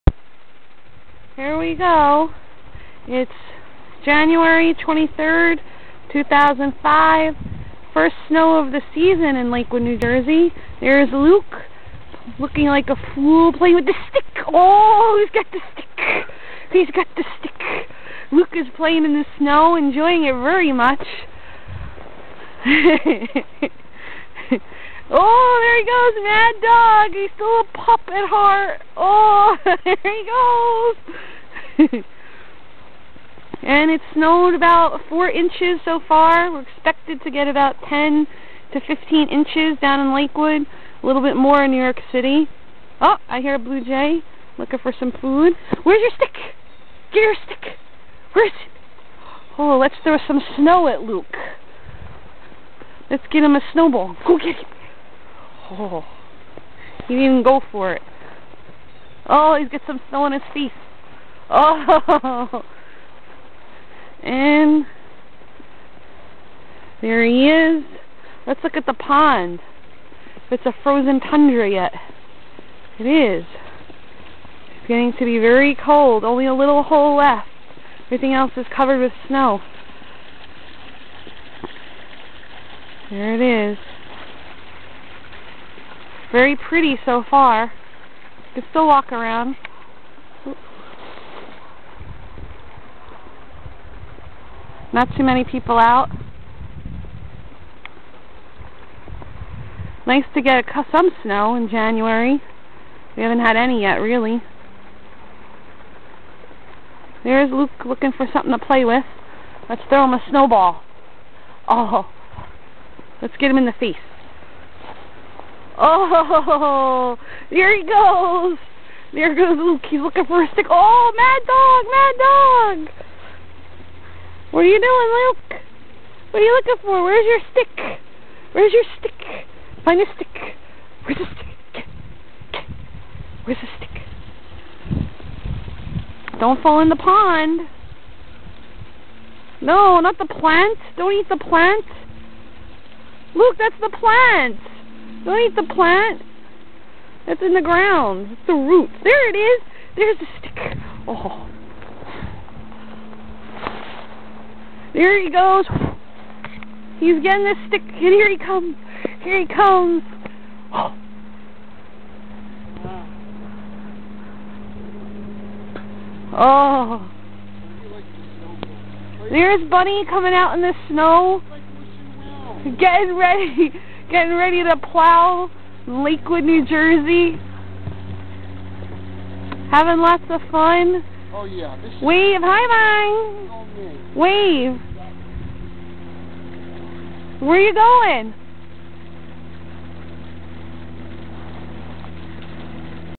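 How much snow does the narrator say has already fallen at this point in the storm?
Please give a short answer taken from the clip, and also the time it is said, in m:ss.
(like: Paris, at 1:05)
4 inches, at 0:35.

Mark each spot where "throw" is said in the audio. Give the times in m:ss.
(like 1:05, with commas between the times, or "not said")
0:50, 1:49.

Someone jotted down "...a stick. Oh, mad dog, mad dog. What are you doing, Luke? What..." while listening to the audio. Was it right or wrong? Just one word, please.
right.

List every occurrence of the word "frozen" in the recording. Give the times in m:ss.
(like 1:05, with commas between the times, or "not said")
1:10.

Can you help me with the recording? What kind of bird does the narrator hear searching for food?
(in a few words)
Blue jay.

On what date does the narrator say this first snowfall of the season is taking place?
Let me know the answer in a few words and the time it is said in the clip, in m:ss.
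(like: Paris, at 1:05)
January 23rd, 2005, at 0:04.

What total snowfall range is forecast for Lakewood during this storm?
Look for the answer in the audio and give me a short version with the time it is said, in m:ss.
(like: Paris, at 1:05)
10 to 15 inches, at 0:37.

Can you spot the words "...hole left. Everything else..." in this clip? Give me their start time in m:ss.
1:16.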